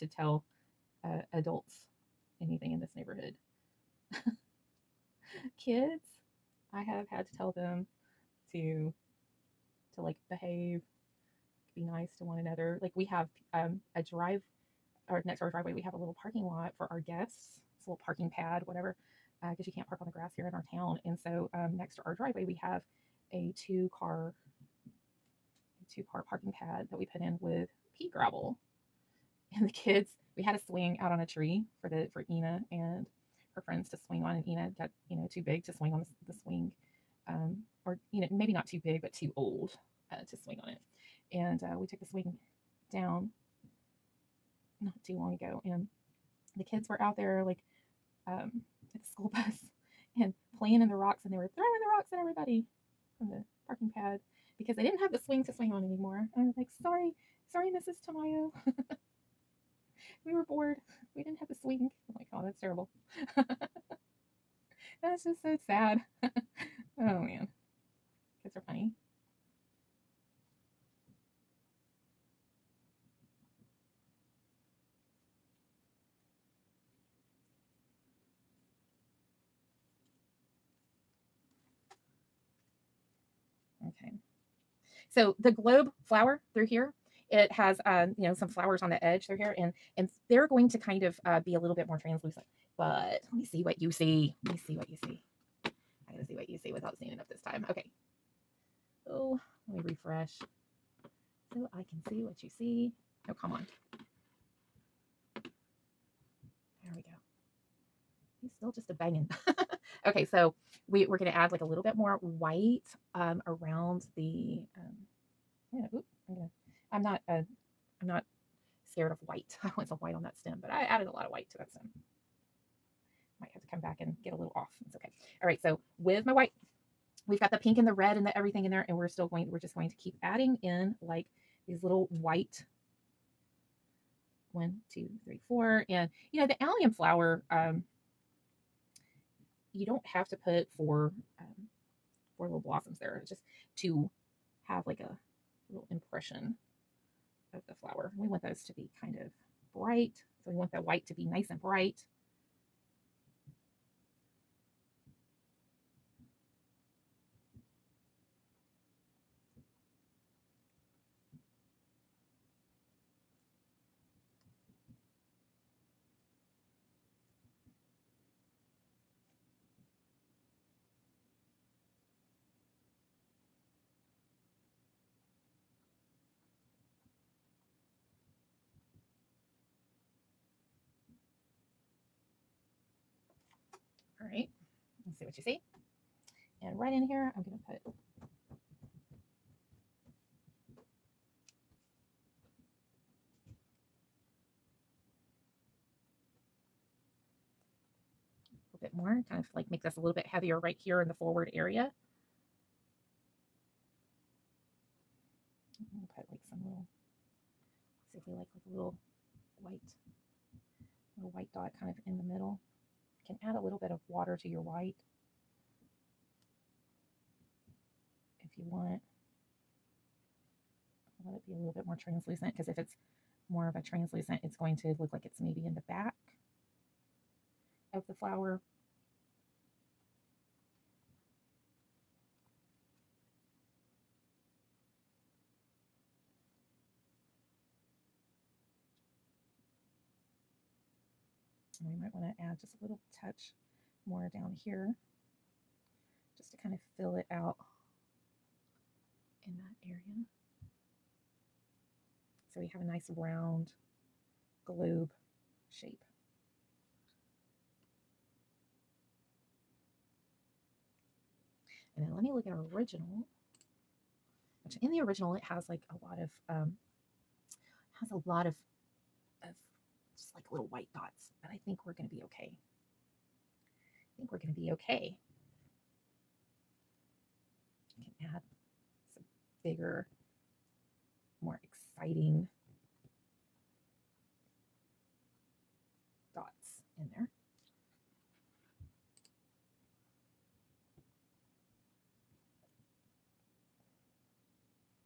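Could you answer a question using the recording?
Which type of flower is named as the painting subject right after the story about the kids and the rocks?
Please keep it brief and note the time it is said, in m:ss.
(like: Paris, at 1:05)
globe flower, at 1:25.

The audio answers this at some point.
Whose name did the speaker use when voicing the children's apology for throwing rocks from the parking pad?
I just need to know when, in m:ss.
0:57.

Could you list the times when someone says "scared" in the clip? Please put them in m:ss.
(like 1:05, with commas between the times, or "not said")
1:58.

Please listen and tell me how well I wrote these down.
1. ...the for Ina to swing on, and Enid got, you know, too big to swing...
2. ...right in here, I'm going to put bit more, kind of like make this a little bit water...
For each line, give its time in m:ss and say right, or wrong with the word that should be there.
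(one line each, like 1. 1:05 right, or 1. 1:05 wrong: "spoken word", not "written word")
1. 0:31 right
2. 3:06 wrong: "heavier", not "water".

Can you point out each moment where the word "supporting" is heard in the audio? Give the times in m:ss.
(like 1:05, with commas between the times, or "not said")
not said.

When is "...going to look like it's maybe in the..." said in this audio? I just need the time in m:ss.
3:44.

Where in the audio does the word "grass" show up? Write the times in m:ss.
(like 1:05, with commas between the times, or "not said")
0:20.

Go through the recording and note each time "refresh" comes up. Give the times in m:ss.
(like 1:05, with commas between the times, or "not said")
1:40.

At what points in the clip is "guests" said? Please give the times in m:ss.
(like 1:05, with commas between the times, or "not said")
0:17.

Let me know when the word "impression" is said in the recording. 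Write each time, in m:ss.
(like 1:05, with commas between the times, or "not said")
2:25.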